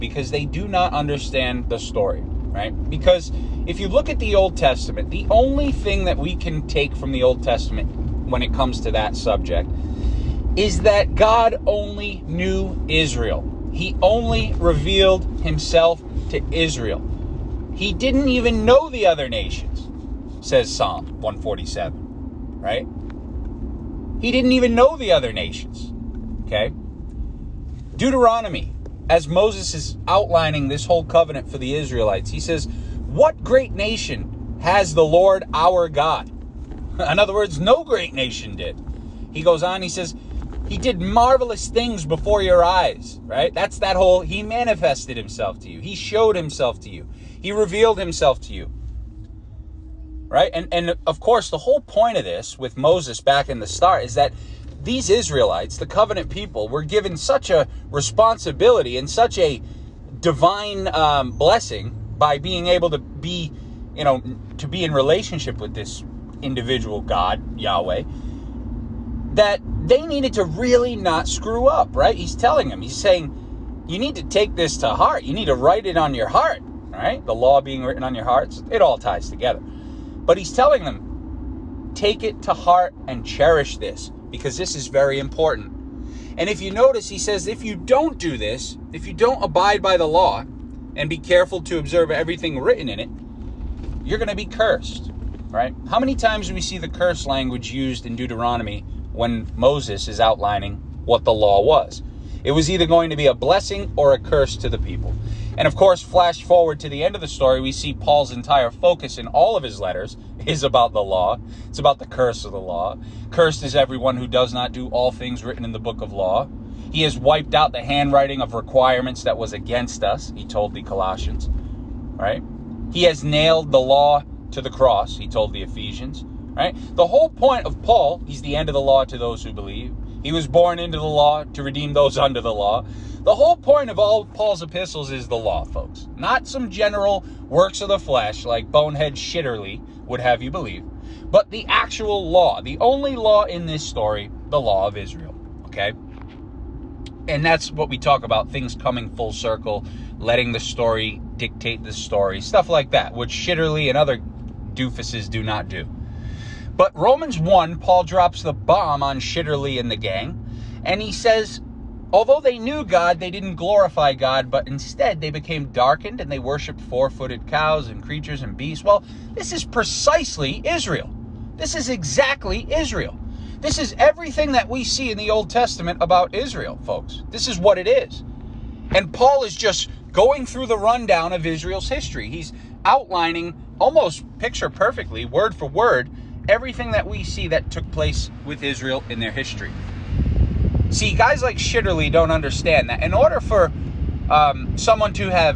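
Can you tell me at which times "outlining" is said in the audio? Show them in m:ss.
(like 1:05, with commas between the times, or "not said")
0:30, 1:40, 3:02.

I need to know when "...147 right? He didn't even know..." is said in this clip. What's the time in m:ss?
0:21.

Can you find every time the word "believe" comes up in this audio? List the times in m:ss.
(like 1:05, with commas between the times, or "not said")
2:09, 2:20.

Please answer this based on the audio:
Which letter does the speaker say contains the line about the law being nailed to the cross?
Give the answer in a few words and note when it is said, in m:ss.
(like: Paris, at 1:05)
Ephesians, at 2:05.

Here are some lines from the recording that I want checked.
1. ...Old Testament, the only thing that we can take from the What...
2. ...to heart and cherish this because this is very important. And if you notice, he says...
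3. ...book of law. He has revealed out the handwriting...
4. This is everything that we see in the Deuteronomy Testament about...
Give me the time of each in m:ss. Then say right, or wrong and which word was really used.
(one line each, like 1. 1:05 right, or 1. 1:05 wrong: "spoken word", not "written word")
1. 0:04 wrong: "Old", not "What"
2. 1:22 right
3. 1:55 wrong: "wiped", not "revealed"
4. 2:53 wrong: "Old", not "Deuteronomy".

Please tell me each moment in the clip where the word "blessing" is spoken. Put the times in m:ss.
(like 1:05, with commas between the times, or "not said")
1:01, 1:43.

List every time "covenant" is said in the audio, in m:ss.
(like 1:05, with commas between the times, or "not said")
0:31, 0:55.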